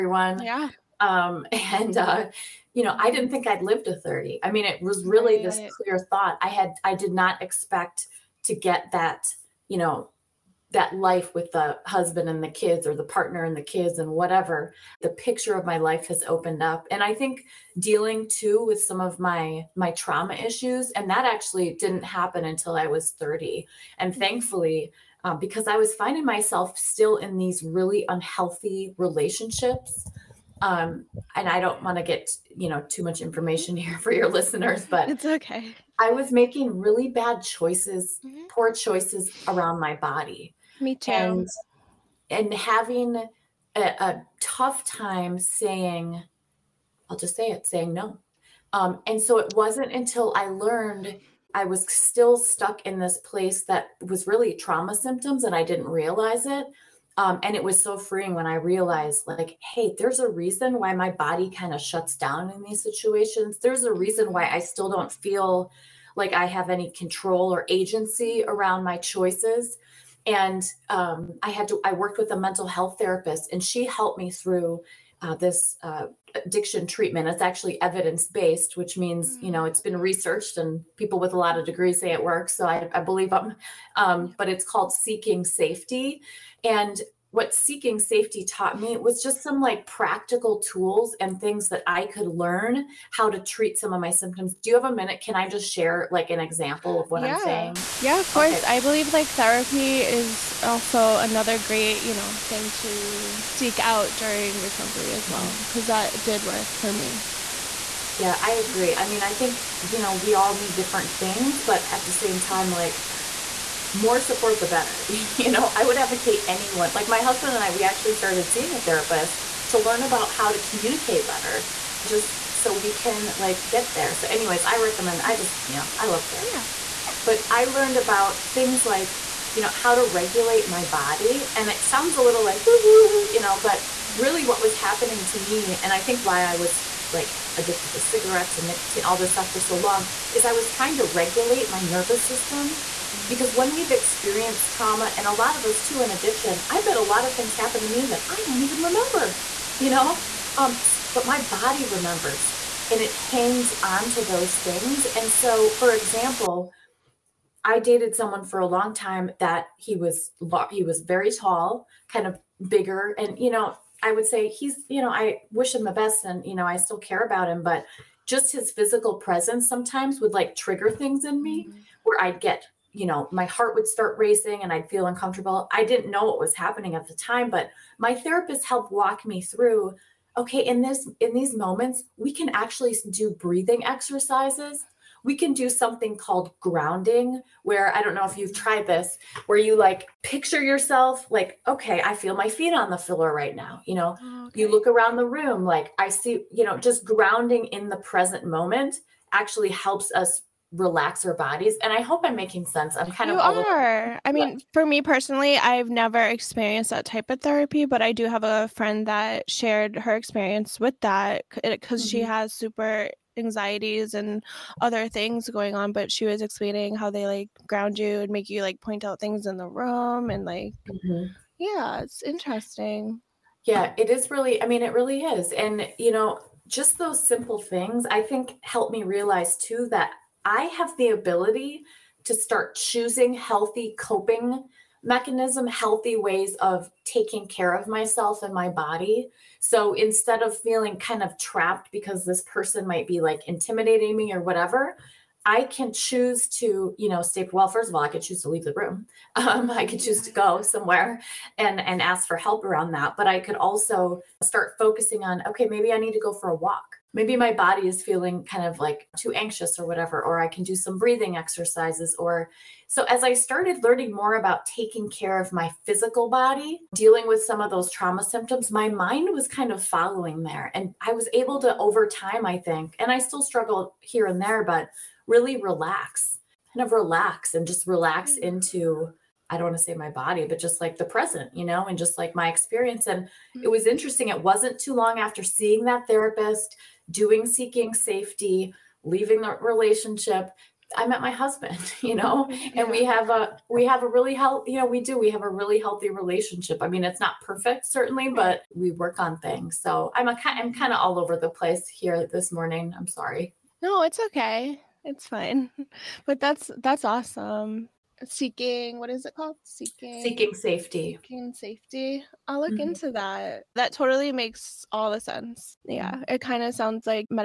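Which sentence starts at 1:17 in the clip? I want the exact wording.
It's actually evidence based, which means mm-hmm.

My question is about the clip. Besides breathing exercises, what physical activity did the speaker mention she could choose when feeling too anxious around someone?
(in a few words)
go for a walk.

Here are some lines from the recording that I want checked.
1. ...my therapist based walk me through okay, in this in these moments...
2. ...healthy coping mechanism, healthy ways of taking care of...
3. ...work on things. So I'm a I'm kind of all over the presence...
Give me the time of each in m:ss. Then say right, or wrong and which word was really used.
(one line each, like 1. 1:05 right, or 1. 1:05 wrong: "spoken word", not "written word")
1. 2:57 wrong: "helped", not "based"
2. 3:53 right
3. 4:58 wrong: "place", not "presence".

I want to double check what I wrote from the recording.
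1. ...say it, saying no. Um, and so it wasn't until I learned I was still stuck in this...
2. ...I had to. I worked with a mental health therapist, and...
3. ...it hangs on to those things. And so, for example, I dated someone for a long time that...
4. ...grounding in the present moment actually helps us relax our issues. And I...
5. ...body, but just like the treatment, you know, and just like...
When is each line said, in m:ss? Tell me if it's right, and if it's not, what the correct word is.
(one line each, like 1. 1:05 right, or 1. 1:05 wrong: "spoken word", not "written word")
1. 0:47 right
2. 1:11 right
3. 2:33 right
4. 3:17 wrong: "bodies", not "issues"
5. 4:40 wrong: "present", not "treatment".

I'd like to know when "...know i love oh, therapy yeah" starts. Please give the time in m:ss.
2:05.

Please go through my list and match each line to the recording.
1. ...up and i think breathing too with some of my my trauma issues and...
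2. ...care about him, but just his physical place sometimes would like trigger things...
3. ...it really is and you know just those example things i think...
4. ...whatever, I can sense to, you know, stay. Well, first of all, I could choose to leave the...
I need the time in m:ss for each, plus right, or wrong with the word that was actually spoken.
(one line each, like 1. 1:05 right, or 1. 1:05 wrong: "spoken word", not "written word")
1. 0:16 wrong: "dealing", not "breathing"
2. 2:46 wrong: "presence", not "place"
3. 3:44 wrong: "simple", not "example"
4. 4:04 wrong: "choose", not "sense".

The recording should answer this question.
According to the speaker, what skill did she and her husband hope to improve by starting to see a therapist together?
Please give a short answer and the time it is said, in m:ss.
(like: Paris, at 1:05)
communicate better, at 2:00.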